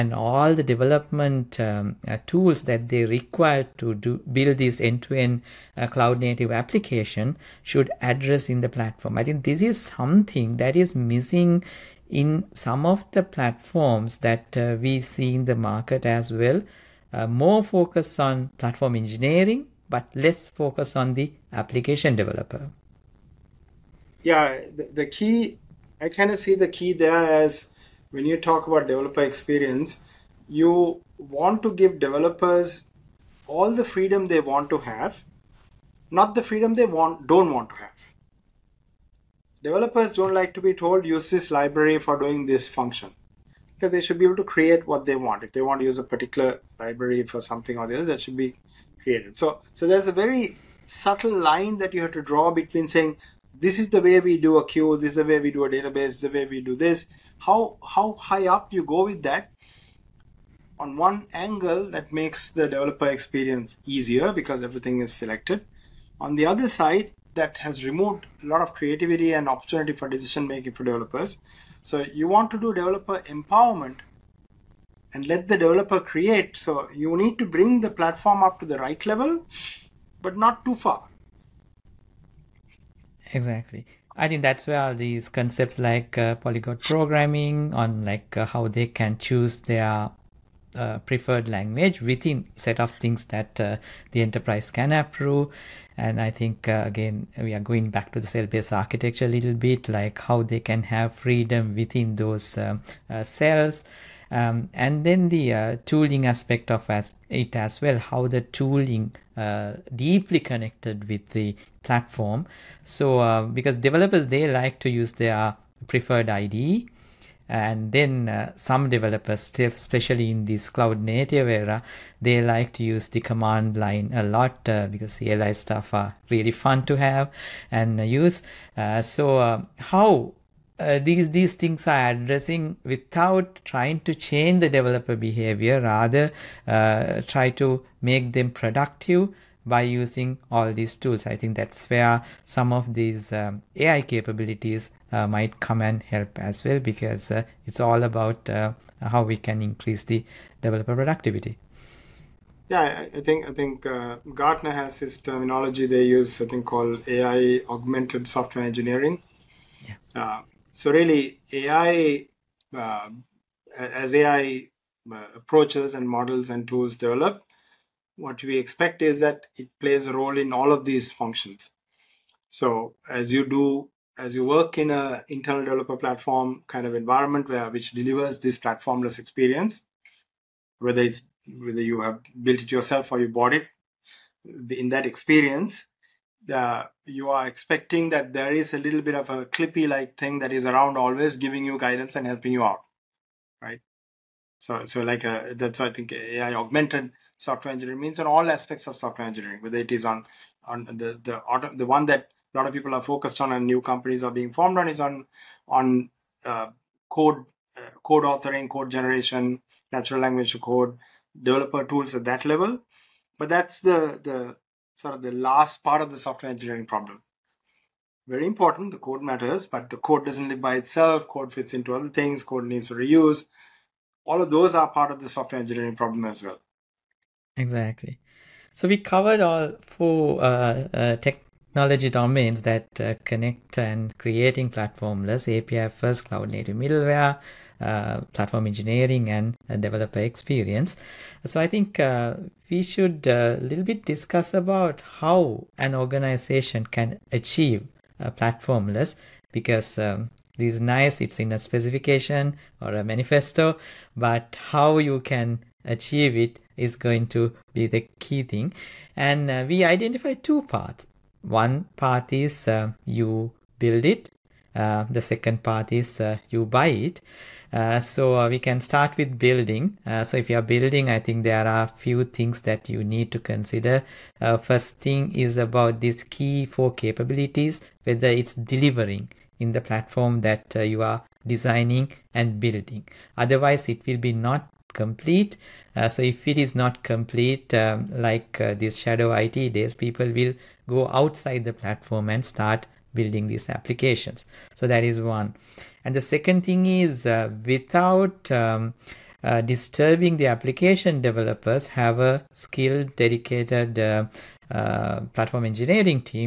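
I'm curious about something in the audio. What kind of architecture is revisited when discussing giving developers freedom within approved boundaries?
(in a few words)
cell-based architecture.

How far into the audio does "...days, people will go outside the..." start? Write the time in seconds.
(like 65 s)
289 s.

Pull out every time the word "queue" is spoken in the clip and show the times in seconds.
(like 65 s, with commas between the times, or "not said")
54 s.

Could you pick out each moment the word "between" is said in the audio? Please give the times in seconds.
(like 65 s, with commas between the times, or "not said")
52 s.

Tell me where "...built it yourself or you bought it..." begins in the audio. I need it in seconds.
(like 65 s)
182 s.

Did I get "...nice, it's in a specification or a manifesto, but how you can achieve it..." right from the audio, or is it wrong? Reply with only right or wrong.
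right.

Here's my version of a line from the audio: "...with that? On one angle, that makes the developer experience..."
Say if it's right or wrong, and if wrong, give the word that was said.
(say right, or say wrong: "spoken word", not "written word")
right.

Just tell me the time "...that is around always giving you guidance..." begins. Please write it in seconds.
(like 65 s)
190 s.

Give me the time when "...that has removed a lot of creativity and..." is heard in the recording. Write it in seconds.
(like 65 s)
67 s.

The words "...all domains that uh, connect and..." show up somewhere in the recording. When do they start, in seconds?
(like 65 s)
231 s.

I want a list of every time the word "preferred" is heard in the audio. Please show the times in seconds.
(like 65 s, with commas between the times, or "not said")
91 s, 115 s.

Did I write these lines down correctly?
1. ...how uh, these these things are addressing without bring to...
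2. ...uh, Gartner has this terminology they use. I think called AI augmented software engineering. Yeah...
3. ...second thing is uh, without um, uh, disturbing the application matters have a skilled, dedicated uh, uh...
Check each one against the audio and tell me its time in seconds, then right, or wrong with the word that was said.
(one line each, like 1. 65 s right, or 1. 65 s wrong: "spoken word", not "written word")
1. 129 s wrong: "trying", not "bring"
2. 153 s right
3. 296 s wrong: "developers", not "matters".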